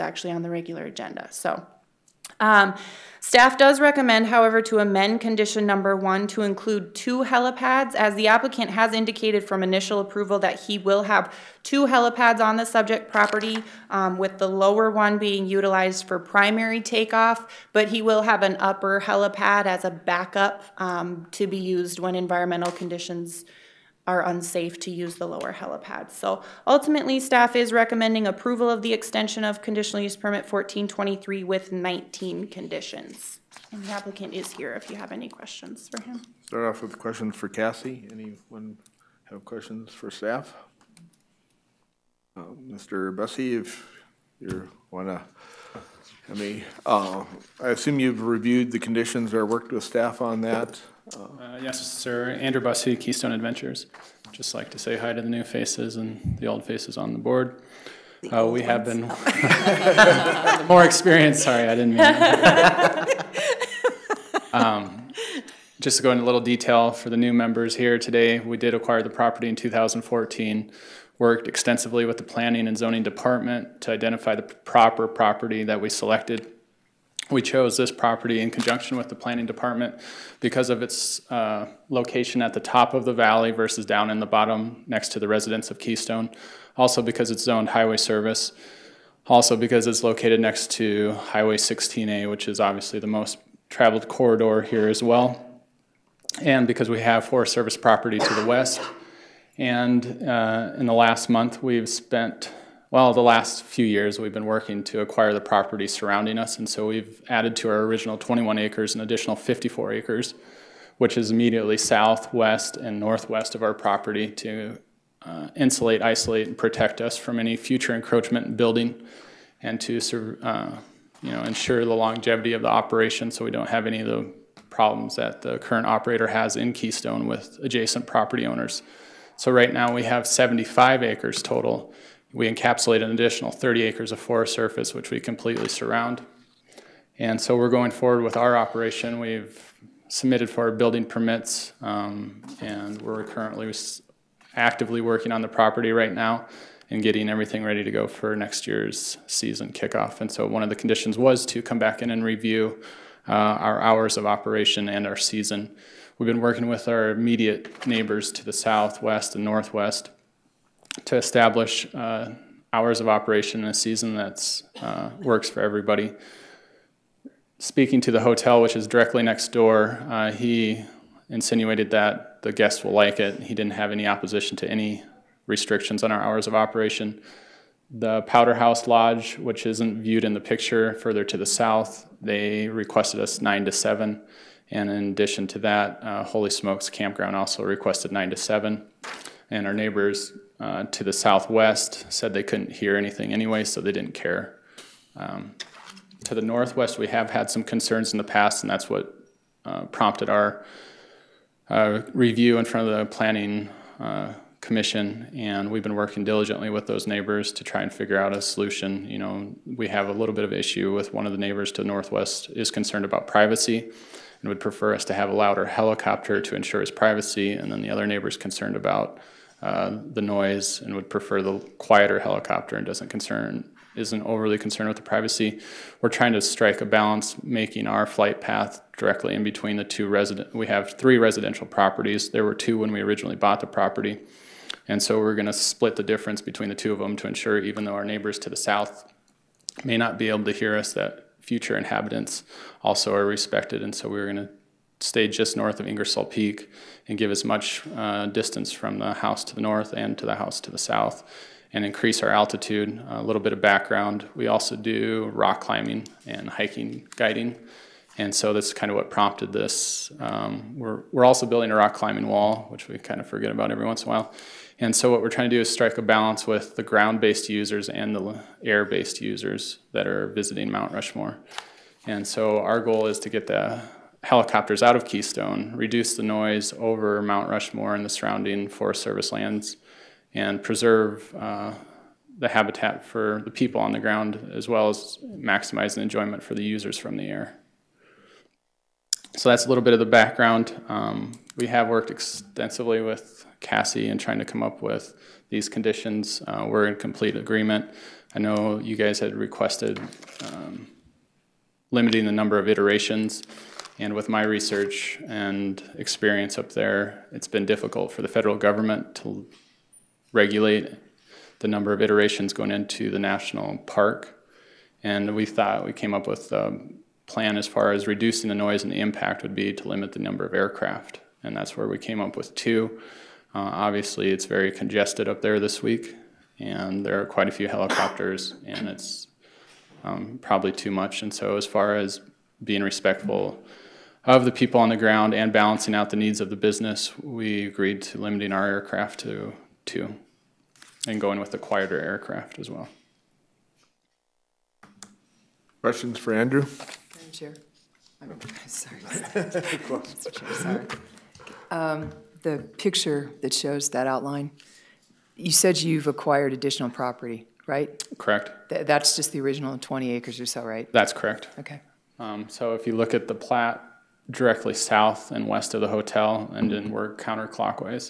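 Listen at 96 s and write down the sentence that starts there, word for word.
And because we have Forest Service property to the west.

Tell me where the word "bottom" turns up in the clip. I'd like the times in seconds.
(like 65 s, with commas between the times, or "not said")
84 s.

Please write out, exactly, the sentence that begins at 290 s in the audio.
Um, we have worked extensively with Cassie in trying to come up with these conditions.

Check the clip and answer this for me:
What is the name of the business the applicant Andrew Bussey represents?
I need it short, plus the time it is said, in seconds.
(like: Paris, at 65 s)
Keystone Adventures, at 52 s.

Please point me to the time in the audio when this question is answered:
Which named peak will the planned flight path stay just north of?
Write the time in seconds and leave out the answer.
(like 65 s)
245 s.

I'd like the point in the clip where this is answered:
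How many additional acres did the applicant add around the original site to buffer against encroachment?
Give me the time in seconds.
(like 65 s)
109 s.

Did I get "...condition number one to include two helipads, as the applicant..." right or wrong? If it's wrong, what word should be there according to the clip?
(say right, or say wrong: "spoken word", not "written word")
right.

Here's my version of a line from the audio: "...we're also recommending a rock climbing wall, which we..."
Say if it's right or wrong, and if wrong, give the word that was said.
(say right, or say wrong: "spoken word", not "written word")
wrong: "building", not "recommending".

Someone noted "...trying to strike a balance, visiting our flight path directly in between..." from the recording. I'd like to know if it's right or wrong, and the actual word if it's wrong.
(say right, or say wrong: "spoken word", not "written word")
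wrong: "making", not "visiting".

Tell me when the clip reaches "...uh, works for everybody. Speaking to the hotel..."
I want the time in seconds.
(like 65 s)
164 s.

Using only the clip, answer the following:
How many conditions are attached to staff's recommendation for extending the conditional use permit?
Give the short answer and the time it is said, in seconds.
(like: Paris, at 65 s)
19, at 31 s.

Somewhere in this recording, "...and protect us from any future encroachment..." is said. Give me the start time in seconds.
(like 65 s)
116 s.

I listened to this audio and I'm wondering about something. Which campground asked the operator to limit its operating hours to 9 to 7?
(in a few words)
Holy Smokes Campground.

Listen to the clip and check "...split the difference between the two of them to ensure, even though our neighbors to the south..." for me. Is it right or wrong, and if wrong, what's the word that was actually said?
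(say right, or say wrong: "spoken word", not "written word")
right.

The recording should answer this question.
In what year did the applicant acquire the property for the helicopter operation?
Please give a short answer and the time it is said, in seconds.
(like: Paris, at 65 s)
2014, at 69 s.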